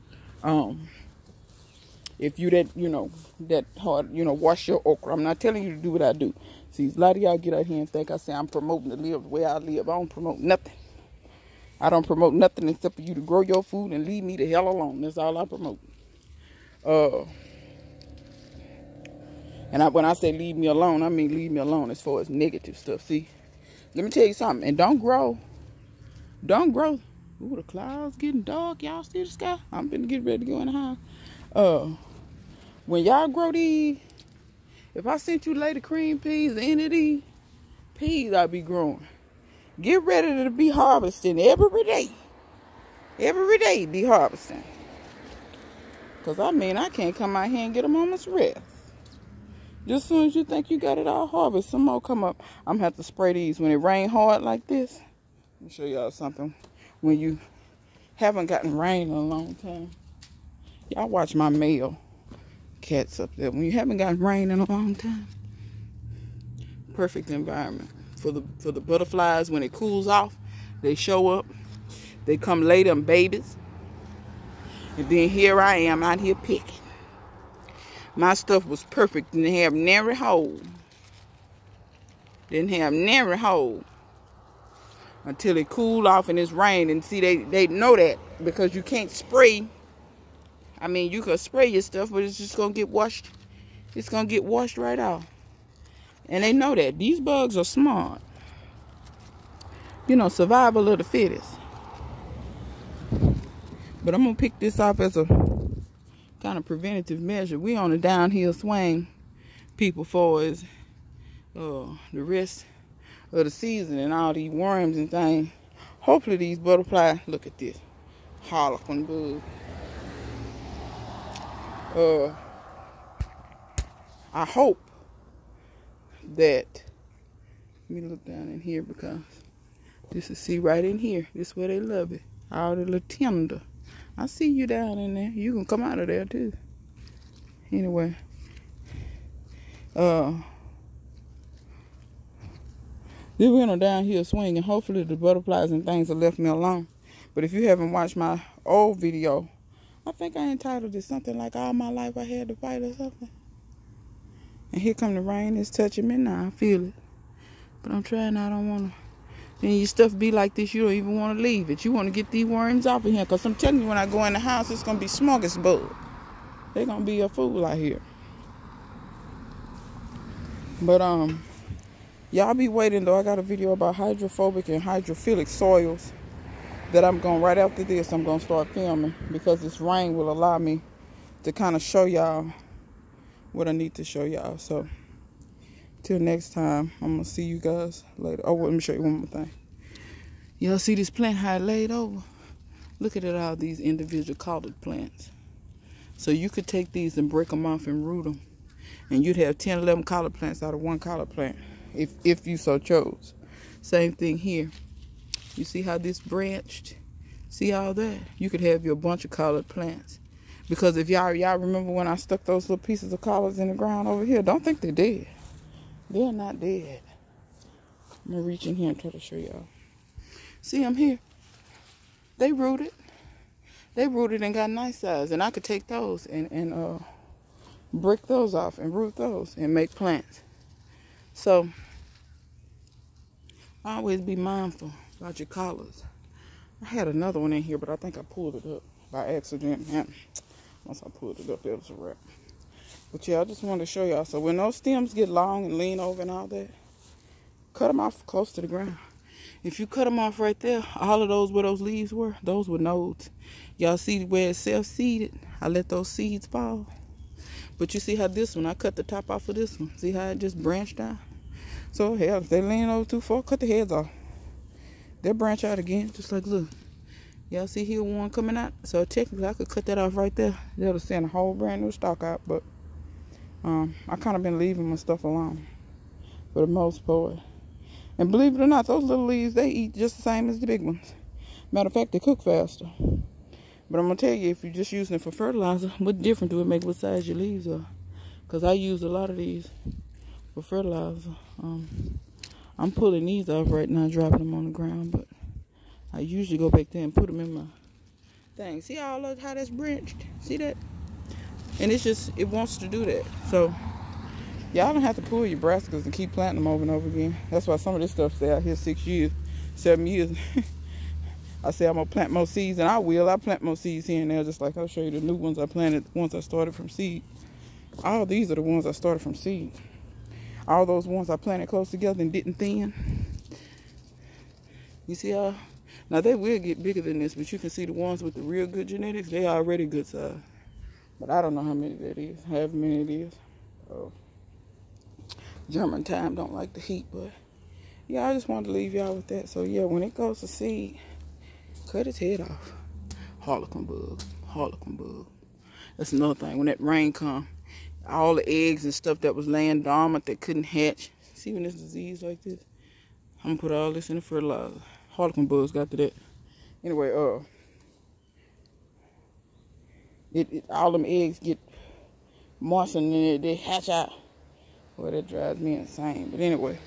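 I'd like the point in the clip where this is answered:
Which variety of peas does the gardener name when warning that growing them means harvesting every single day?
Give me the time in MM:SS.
00:35.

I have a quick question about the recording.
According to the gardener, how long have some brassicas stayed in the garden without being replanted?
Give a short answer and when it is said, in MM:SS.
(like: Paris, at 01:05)
6 or 7 years, at 05:08.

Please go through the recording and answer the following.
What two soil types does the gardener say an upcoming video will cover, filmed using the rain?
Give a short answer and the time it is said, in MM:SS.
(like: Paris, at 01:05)
Hydrophobic and hydrophilic, at 02:53.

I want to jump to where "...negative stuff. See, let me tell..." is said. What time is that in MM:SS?
00:22.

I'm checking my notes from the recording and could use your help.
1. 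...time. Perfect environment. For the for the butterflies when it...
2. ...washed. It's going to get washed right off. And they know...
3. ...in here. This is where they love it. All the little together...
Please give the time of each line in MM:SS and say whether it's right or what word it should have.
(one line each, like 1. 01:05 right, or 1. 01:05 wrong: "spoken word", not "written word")
1. 01:04 right
2. 01:32 right
3. 02:10 wrong: "tender", not "together".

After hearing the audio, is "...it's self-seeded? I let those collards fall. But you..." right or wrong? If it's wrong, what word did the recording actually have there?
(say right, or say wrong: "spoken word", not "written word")
wrong: "seeds", not "collards".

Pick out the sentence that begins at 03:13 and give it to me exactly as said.
Look at it, all these individual collard plants.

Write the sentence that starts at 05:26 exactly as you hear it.
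Now they will get bigger than this, but you can see the ones with the real good genetics, they already good size.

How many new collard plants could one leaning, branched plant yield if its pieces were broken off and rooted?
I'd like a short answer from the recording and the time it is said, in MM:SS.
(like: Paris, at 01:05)
10, 11, at 03:19.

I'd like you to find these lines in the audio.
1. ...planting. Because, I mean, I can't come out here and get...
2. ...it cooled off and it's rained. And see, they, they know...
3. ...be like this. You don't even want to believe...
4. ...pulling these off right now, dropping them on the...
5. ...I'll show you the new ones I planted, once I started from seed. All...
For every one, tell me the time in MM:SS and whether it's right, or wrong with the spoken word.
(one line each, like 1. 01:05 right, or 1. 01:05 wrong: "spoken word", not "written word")
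1. 00:44 wrong: "harvesting", not "planting"
2. 01:25 right
3. 02:40 wrong: "leave", not "believe"
4. 04:52 right
5. 05:14 right.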